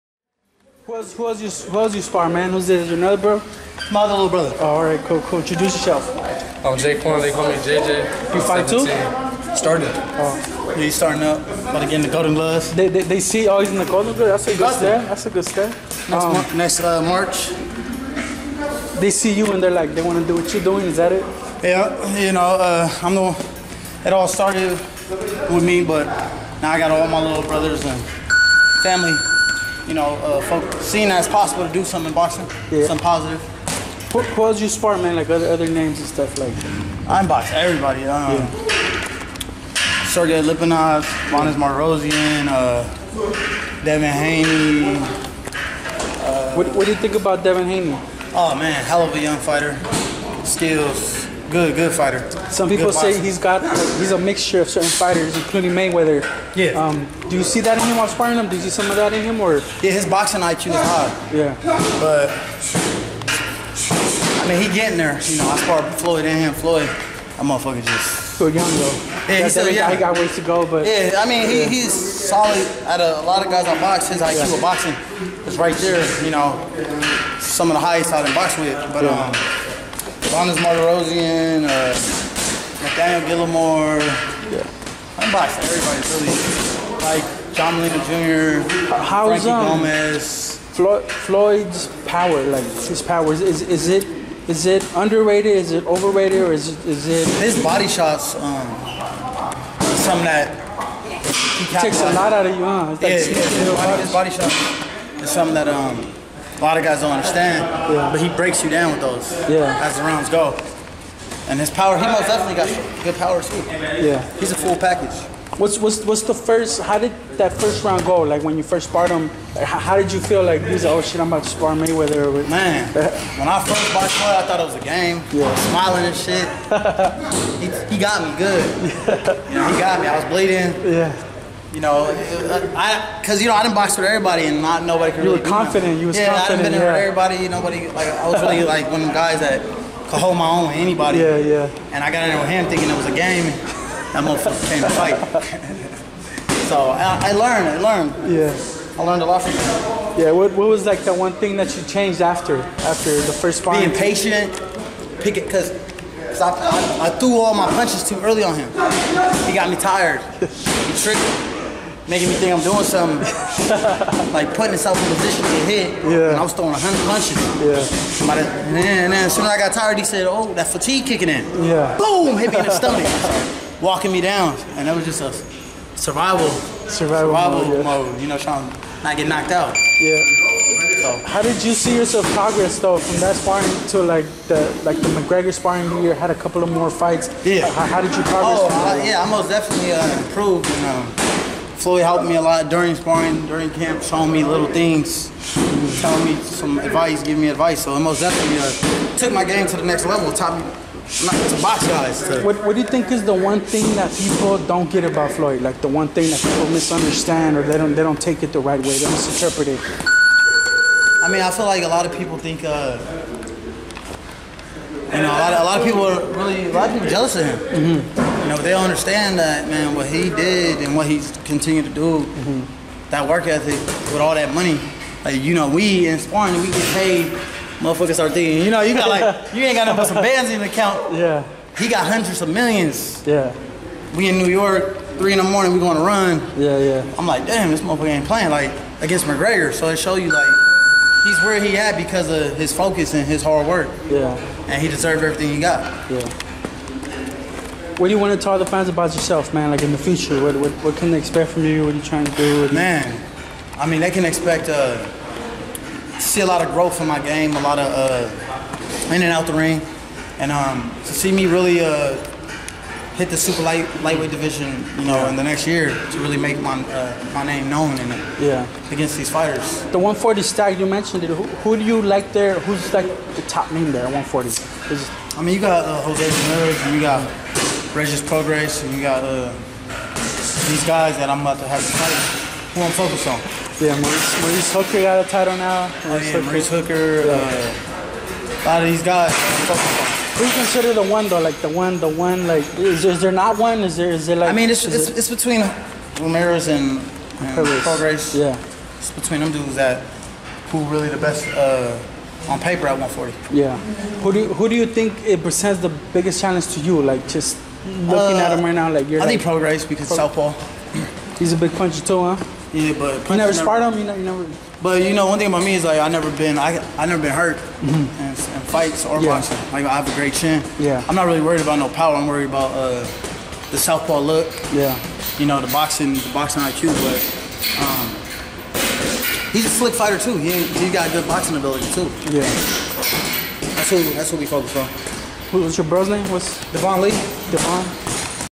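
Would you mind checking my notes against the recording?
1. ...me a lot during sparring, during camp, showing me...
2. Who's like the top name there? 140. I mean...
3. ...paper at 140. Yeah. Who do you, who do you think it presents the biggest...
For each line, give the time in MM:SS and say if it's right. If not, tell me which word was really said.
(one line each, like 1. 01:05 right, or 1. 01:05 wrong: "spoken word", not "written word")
1. 03:12 right
2. 04:32 right
3. 05:02 right.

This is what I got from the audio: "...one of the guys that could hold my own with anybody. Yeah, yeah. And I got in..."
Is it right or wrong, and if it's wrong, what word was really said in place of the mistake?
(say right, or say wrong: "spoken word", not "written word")
right.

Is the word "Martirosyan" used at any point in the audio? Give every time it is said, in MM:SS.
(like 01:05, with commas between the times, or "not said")
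00:41, 01:20.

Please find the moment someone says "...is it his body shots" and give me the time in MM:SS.
01:36.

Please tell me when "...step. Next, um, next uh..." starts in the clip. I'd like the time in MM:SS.
00:15.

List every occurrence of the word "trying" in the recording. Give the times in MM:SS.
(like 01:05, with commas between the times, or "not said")
02:58, 04:12.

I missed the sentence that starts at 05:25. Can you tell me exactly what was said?
You know the boxing the boxing IQ, but um, he's a slick fighter too.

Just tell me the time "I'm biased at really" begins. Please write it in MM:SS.
01:25.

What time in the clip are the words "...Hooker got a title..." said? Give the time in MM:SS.
04:44.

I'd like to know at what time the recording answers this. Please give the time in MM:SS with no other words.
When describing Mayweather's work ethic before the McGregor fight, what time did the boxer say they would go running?
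03:55.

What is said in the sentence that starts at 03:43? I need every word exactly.
that work ethic with all that money.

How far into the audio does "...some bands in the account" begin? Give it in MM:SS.
03:50.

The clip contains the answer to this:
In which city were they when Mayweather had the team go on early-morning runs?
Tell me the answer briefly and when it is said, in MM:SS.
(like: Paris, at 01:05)
New York, at 03:54.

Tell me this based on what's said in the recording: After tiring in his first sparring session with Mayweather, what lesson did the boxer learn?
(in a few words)
Being patient.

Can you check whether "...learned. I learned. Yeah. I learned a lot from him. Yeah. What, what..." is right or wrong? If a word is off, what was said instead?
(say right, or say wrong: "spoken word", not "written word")
right.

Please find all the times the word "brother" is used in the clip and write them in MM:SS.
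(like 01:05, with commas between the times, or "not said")
00:04, 00:27, 05:35.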